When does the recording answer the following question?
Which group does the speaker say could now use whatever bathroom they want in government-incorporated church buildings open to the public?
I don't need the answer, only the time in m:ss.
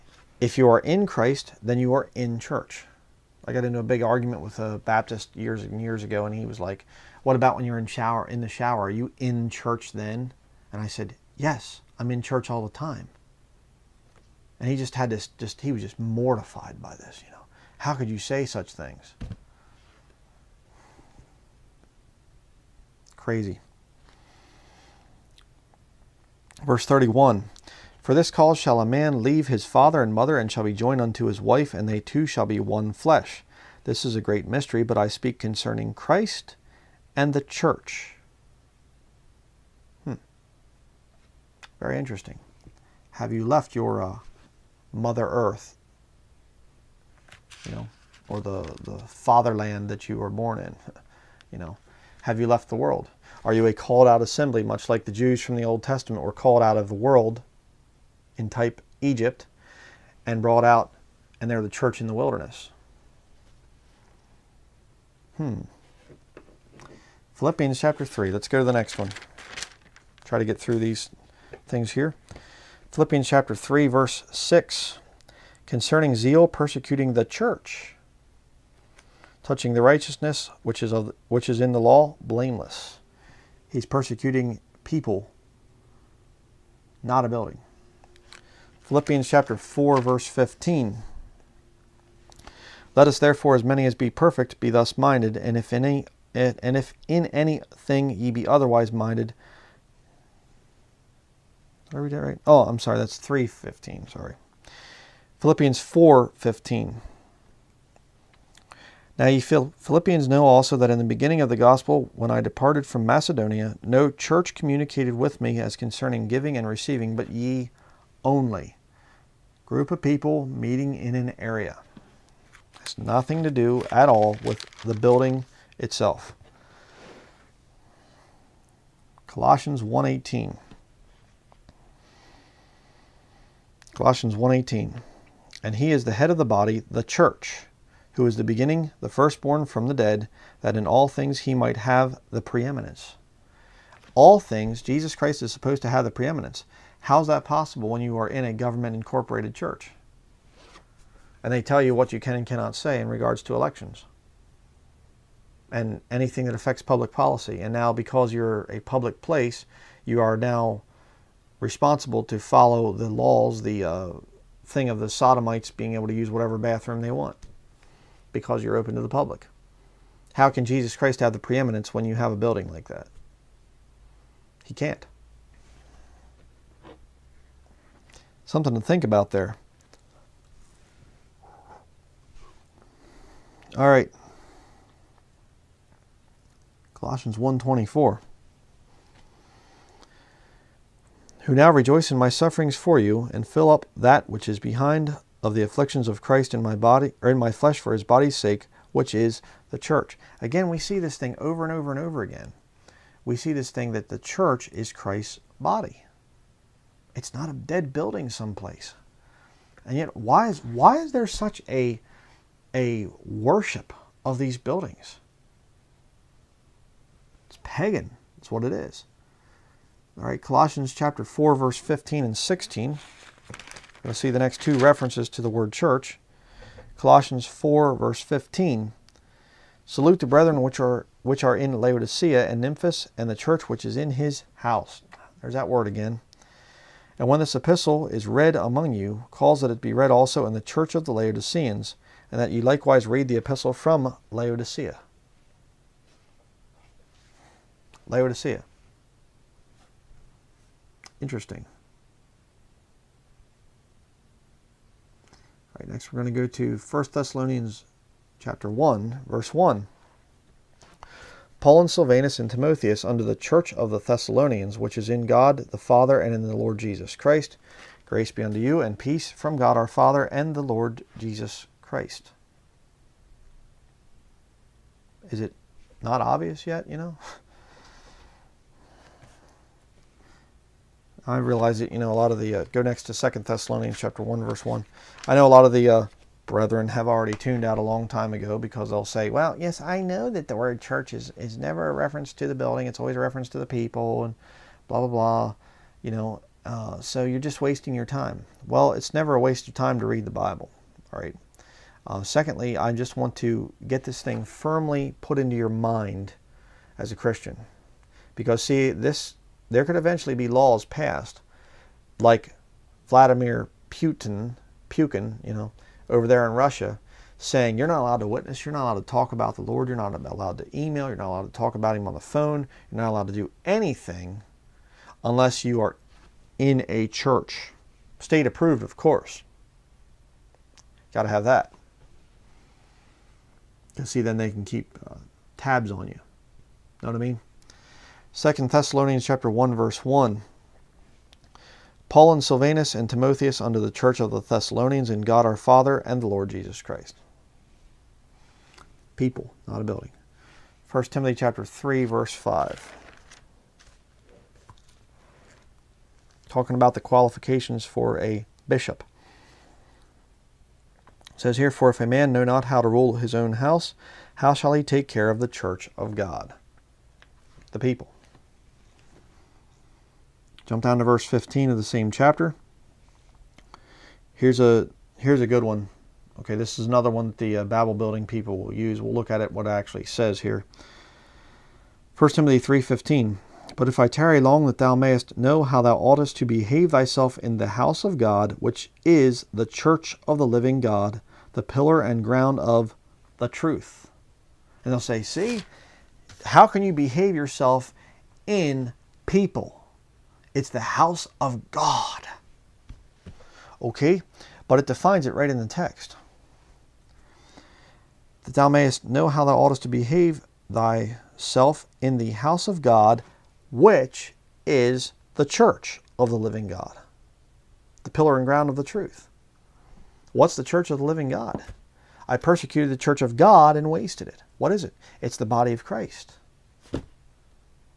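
2:45.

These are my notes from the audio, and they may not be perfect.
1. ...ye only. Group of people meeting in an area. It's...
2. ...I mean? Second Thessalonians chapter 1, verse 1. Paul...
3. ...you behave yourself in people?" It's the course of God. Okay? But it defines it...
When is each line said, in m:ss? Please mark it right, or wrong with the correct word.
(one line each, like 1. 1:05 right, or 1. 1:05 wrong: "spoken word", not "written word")
1. 1:57 right
2. 5:37 right
3. 6:36 wrong: "house", not "course".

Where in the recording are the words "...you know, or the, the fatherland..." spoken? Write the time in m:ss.
0:47.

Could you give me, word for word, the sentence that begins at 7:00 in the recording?
What's the church of the living God?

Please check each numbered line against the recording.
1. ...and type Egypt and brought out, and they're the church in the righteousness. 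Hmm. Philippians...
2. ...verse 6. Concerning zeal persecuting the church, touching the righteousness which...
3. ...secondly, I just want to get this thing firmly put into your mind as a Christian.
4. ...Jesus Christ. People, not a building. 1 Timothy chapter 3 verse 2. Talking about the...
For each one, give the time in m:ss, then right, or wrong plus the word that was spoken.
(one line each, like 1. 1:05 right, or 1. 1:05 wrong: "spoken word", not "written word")
1. 0:58 wrong: "wilderness", not "righteousness"
2. 1:13 right
3. 5:02 right
4. 5:46 wrong: "5", not "2".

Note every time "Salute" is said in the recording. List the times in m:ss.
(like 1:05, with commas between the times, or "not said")
3:49.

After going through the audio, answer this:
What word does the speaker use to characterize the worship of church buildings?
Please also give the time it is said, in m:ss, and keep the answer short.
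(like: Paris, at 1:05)
pagan, at 3:37.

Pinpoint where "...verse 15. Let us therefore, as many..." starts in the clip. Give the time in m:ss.
1:30.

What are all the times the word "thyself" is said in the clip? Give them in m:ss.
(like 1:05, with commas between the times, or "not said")
6:26, 6:50.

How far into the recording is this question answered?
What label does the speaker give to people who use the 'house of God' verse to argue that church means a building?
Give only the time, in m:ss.
6:17.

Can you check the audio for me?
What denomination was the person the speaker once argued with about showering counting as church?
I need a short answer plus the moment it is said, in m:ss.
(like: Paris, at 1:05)
Baptist, at 0:04.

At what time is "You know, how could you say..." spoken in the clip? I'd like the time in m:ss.
0:17.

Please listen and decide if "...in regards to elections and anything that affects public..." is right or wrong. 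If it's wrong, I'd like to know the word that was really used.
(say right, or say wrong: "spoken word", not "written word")
right.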